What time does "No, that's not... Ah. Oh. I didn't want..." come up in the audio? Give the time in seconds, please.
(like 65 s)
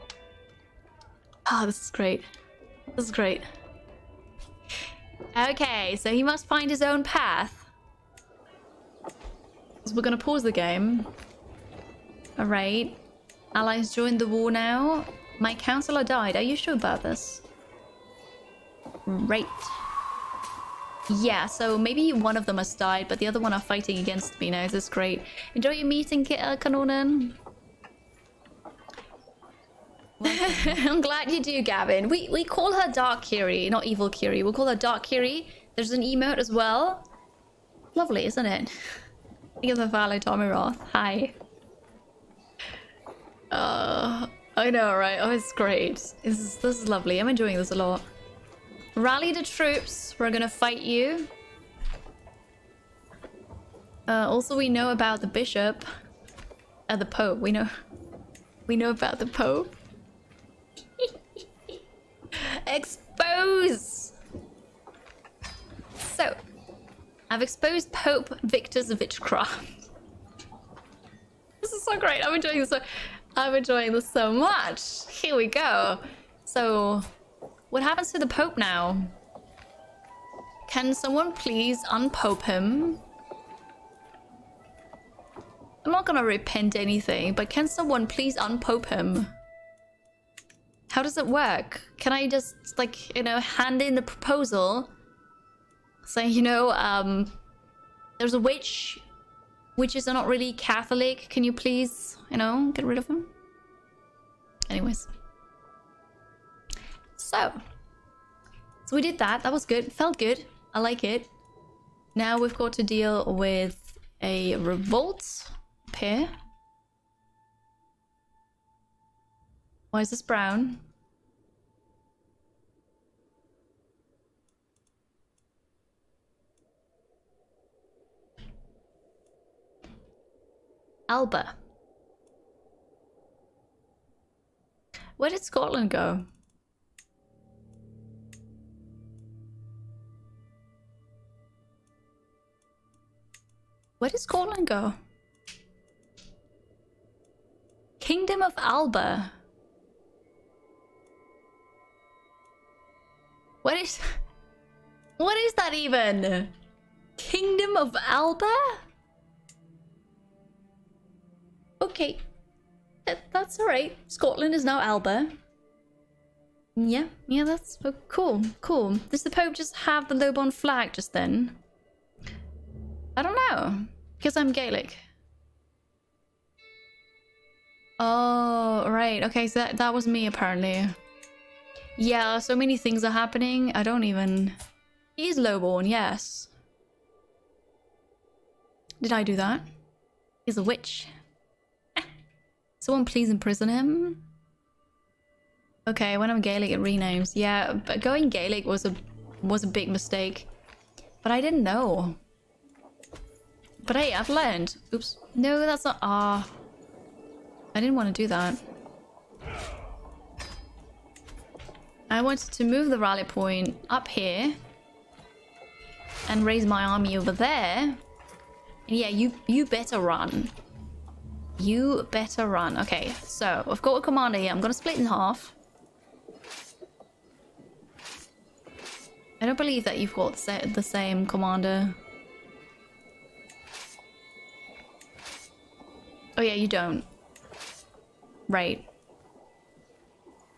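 205 s.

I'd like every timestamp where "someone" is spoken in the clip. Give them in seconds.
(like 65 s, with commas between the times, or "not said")
80 s, 87 s, 192 s.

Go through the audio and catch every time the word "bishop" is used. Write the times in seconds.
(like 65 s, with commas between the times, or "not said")
55 s.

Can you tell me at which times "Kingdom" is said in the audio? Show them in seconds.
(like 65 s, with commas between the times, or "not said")
147 s, 157 s.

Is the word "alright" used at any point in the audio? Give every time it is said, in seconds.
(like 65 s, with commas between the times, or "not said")
12 s, 163 s.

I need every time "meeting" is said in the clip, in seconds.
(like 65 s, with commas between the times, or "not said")
25 s.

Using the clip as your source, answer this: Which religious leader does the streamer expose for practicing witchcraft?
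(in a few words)
Pope Victor.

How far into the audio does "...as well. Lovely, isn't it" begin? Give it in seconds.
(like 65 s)
36 s.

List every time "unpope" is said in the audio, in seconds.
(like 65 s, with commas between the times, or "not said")
81 s, 88 s.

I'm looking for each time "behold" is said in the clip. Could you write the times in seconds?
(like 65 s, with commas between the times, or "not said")
not said.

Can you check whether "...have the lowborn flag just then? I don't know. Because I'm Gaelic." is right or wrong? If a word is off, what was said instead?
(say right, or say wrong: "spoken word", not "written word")
right.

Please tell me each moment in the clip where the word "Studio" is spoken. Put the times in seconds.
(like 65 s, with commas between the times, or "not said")
not said.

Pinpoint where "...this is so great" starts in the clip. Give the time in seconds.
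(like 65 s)
71 s.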